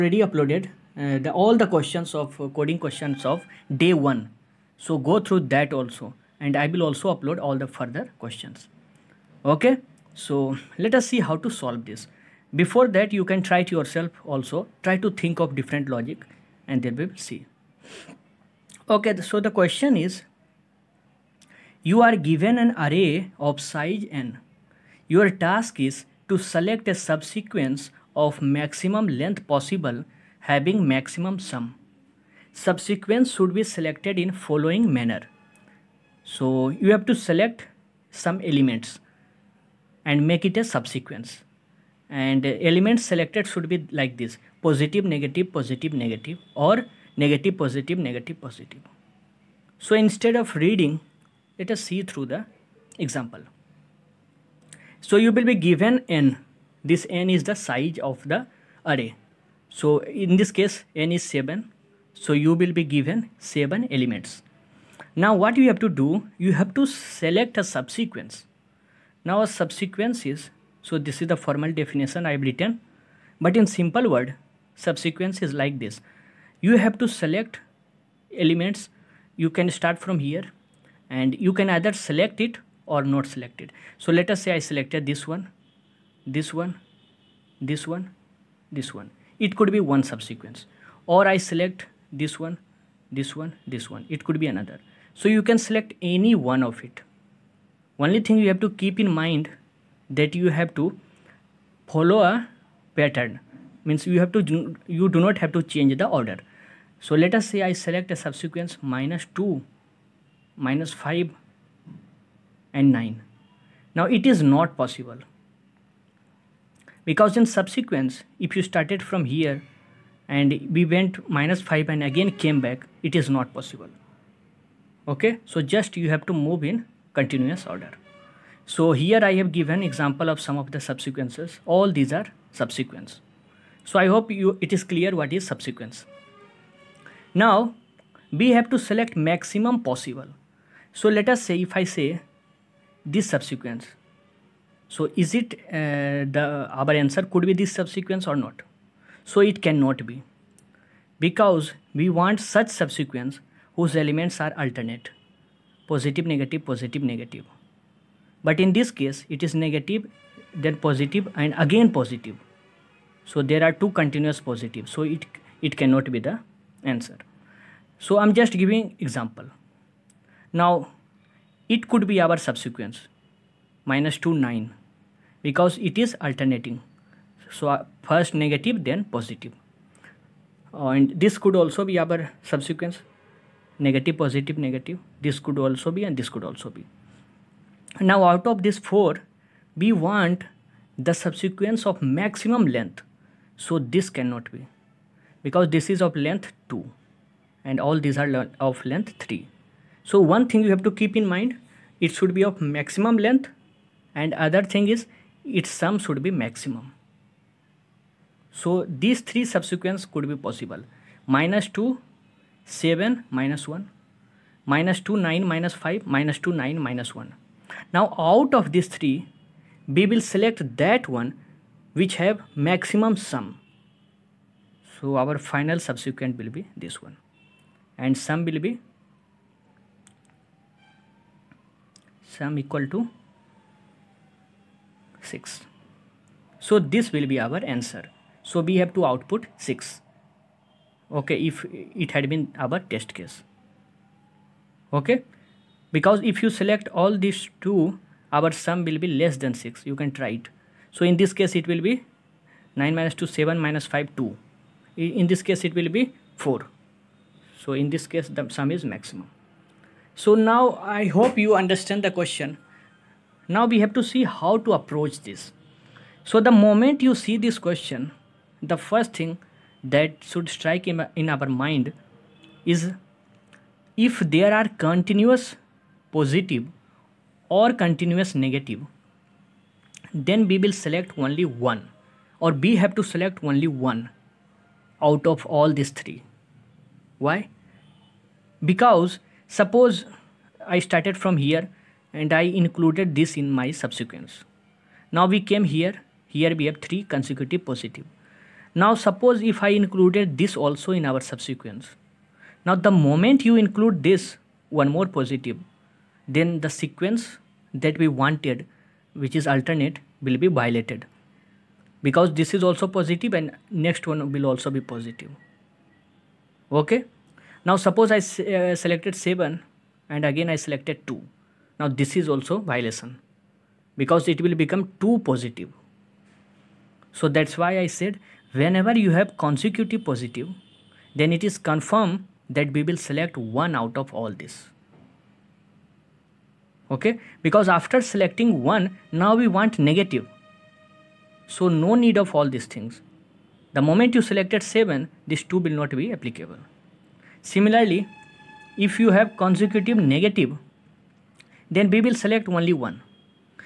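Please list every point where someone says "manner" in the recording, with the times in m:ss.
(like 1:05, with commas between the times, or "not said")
0:34.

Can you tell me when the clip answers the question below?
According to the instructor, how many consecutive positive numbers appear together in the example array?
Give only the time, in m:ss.
4:56.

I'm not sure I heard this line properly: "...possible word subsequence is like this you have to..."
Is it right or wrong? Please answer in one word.
wrong.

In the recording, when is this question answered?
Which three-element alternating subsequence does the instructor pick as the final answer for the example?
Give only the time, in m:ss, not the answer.
3:36.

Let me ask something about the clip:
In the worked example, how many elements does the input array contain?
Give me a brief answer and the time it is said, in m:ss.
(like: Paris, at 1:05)
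7, at 1:01.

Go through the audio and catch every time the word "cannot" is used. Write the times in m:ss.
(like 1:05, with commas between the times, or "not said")
2:29, 2:45, 3:14.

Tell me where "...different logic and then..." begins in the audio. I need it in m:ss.
0:15.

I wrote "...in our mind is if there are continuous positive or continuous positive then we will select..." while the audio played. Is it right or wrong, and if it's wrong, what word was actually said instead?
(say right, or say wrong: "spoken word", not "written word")
wrong: "negative", not "positive".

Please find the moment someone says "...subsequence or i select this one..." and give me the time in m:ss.
1:30.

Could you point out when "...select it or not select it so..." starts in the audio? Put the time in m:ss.
1:21.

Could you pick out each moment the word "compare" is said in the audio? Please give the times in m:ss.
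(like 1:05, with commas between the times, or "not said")
not said.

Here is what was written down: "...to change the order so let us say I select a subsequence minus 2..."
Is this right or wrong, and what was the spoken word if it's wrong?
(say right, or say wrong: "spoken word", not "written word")
right.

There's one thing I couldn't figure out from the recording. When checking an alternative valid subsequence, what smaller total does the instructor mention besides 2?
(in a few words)
4.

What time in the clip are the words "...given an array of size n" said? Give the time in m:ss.
0:22.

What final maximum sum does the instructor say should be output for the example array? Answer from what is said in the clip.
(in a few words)
6.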